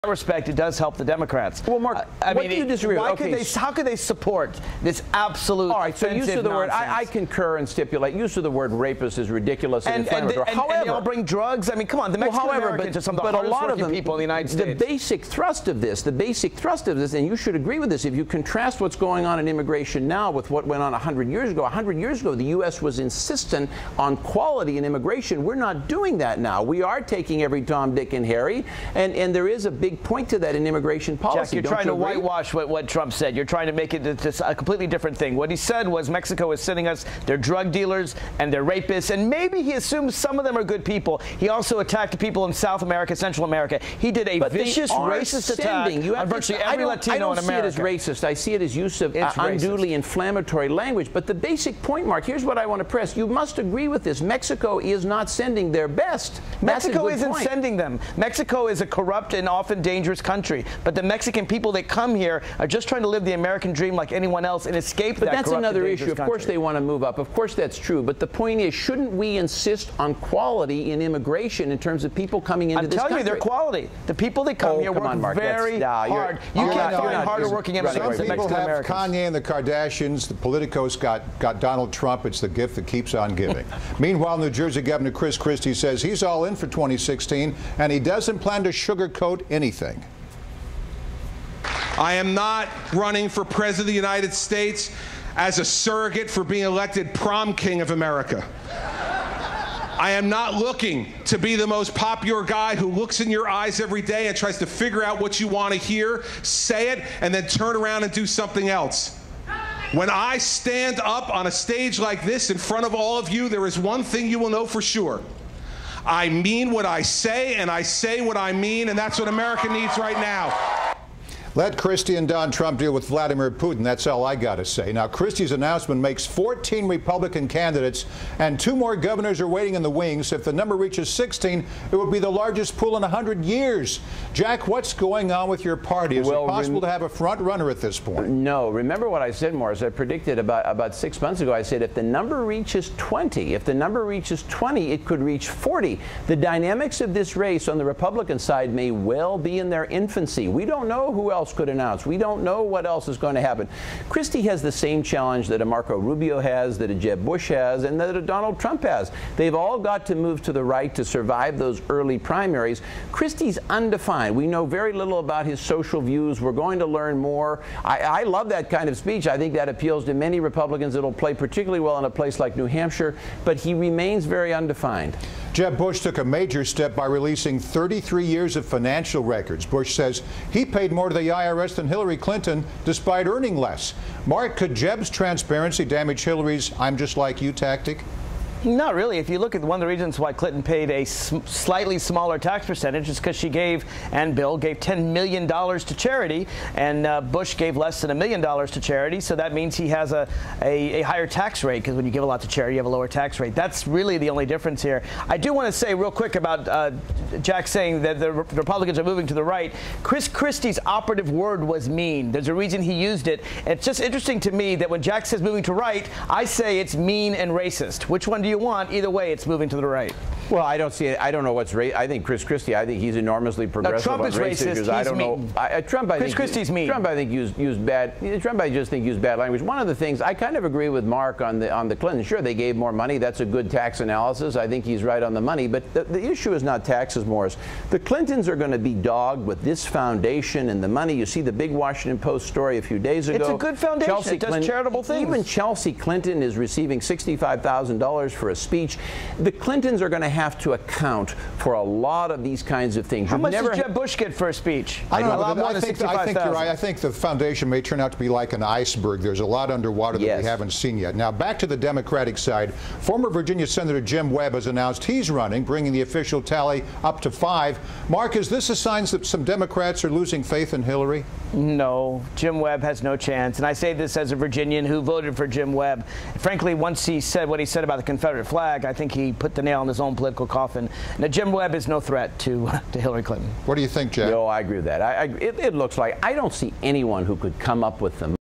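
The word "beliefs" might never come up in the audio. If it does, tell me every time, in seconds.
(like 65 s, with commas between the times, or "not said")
not said.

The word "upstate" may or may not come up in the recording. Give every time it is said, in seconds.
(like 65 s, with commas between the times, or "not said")
not said.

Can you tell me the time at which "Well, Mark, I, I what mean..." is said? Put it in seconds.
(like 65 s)
1 s.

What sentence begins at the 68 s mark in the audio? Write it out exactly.
But the point is, shouldn't we insist on quality in immigration in terms of people coming into I'm this country?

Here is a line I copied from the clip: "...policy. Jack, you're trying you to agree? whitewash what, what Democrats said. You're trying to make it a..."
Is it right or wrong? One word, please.
wrong.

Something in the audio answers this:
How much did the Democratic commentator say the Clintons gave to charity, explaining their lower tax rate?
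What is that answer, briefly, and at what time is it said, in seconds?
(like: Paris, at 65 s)
$10 million, at 194 s.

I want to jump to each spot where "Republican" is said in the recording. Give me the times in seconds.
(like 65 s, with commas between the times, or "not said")
126 s, 147 s, 170 s, 208 s.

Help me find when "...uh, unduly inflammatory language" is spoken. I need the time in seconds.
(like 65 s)
49 s.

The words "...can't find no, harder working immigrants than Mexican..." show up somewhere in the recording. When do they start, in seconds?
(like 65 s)
76 s.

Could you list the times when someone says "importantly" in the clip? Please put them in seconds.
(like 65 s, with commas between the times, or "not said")
not said.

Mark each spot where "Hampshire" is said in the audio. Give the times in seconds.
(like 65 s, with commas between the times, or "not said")
172 s.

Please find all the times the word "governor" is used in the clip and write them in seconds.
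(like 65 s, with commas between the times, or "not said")
84 s, 128 s.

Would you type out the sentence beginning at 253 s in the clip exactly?
How You've much did Jeb Bush get for a speech?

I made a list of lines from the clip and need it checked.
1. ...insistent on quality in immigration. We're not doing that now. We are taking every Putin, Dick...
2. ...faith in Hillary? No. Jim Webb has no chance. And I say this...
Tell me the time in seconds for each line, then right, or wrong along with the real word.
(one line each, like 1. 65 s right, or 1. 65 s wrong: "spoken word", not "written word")
1. 22 s wrong: "Tom", not "Putin"
2. 270 s right.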